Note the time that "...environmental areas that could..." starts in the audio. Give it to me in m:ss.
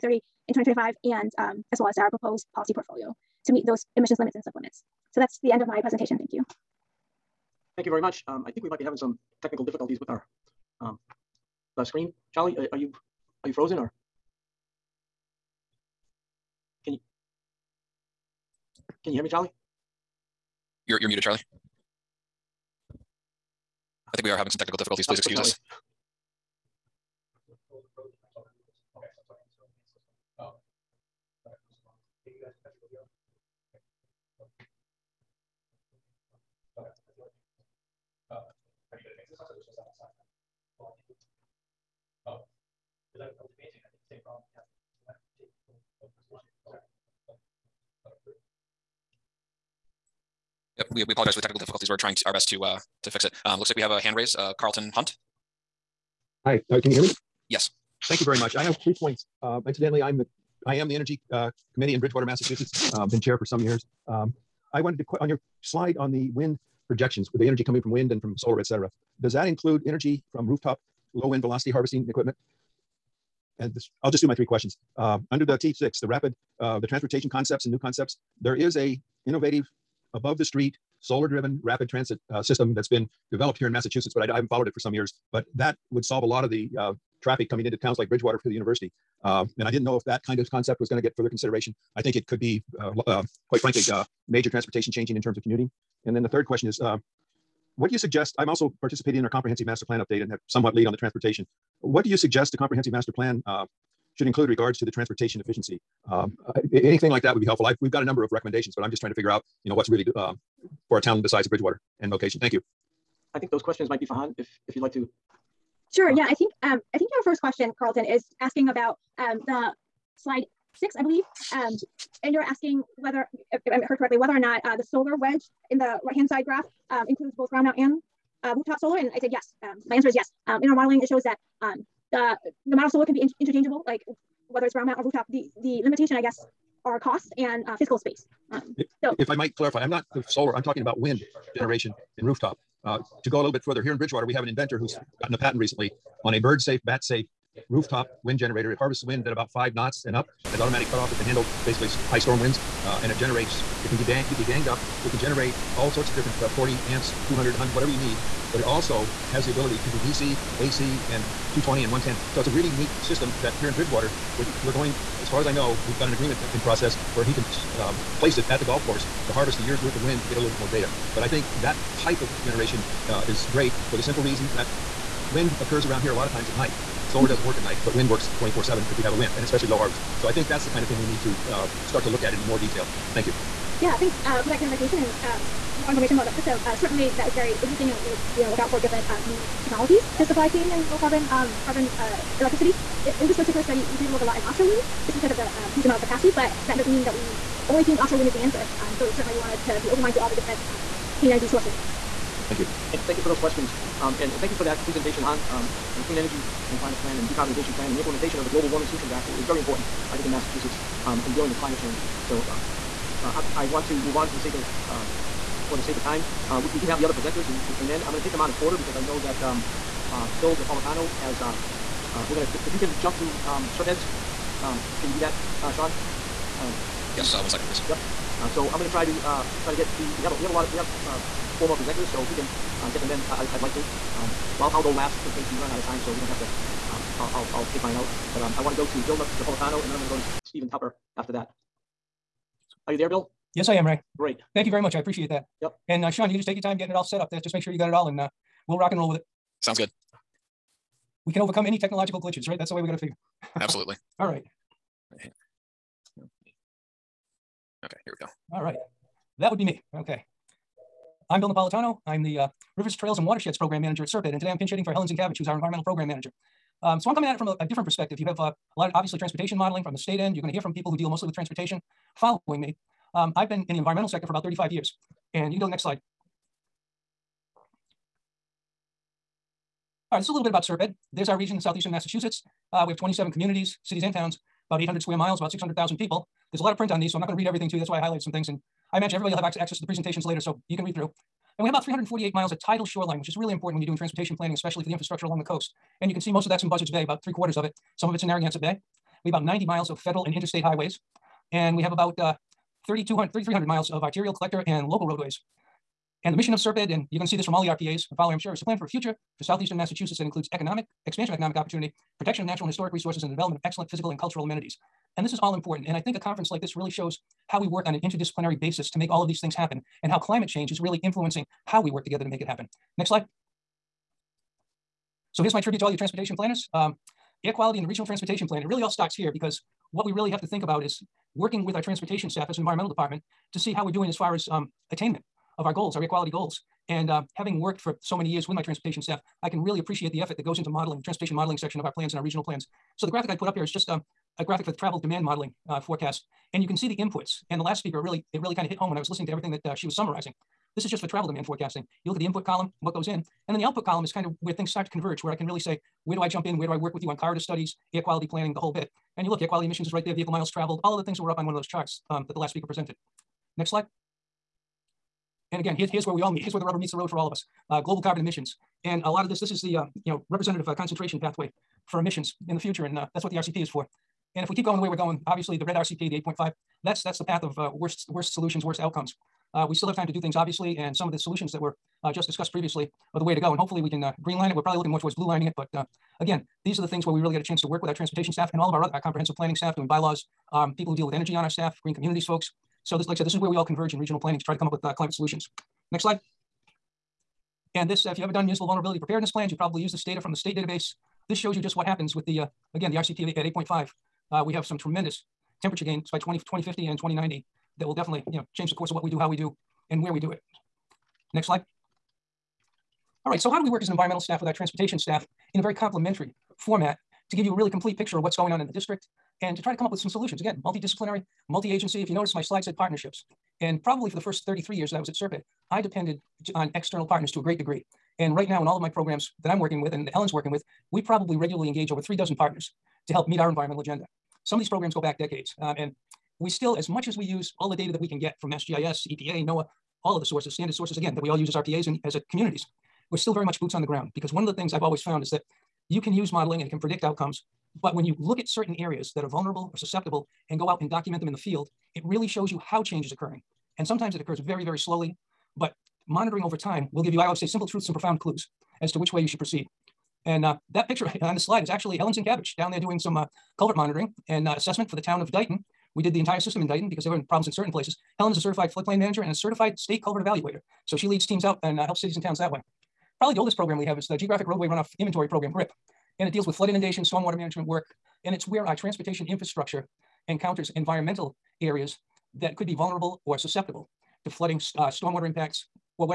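8:00.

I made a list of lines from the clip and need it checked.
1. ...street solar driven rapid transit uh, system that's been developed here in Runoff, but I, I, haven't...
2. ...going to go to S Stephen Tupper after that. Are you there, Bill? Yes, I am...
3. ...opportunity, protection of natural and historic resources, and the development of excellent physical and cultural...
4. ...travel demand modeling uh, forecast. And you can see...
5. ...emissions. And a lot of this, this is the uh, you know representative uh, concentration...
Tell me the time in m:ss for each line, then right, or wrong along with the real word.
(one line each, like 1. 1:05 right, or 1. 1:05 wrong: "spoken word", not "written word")
1. 1:20 wrong: "Massachusetts", not "Runoff"
2. 3:59 right
3. 5:11 right
4. 5:44 right
5. 6:08 right.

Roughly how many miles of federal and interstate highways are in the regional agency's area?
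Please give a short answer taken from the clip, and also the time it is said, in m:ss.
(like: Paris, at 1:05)
90, at 4:59.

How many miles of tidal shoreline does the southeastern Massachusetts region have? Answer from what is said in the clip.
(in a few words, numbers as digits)
348.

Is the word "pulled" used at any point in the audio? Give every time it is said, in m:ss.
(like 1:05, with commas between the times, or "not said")
not said.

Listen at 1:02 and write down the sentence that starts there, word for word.
Um, been chair for some years.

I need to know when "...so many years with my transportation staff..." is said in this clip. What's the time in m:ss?
5:38.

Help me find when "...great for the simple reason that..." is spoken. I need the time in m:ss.
2:53.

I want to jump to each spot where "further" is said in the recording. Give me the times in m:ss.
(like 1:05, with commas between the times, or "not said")
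1:31, 2:23.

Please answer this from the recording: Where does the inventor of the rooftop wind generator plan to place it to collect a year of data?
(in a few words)
the golf course.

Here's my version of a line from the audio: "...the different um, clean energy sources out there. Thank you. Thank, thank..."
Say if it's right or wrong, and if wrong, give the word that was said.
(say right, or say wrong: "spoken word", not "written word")
right.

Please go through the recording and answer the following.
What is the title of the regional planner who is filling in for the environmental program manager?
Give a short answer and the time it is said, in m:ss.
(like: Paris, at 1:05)
Rivers, Trails, and Watersheds Program Manager, at 4:22.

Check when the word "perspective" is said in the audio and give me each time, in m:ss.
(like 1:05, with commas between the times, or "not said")
4:27.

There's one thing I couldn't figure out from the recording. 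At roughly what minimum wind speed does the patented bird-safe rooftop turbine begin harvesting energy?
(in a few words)
5 knots.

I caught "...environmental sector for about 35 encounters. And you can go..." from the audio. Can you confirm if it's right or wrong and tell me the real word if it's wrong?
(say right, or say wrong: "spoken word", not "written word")
wrong: "years", not "encounters".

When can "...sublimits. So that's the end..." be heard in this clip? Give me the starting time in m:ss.
0:04.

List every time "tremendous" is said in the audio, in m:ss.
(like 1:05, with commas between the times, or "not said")
6:44.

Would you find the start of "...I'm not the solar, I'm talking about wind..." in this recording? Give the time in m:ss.
2:19.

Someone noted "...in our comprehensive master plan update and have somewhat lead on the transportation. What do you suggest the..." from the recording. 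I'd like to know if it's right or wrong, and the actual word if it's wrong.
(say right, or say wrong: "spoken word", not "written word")
right.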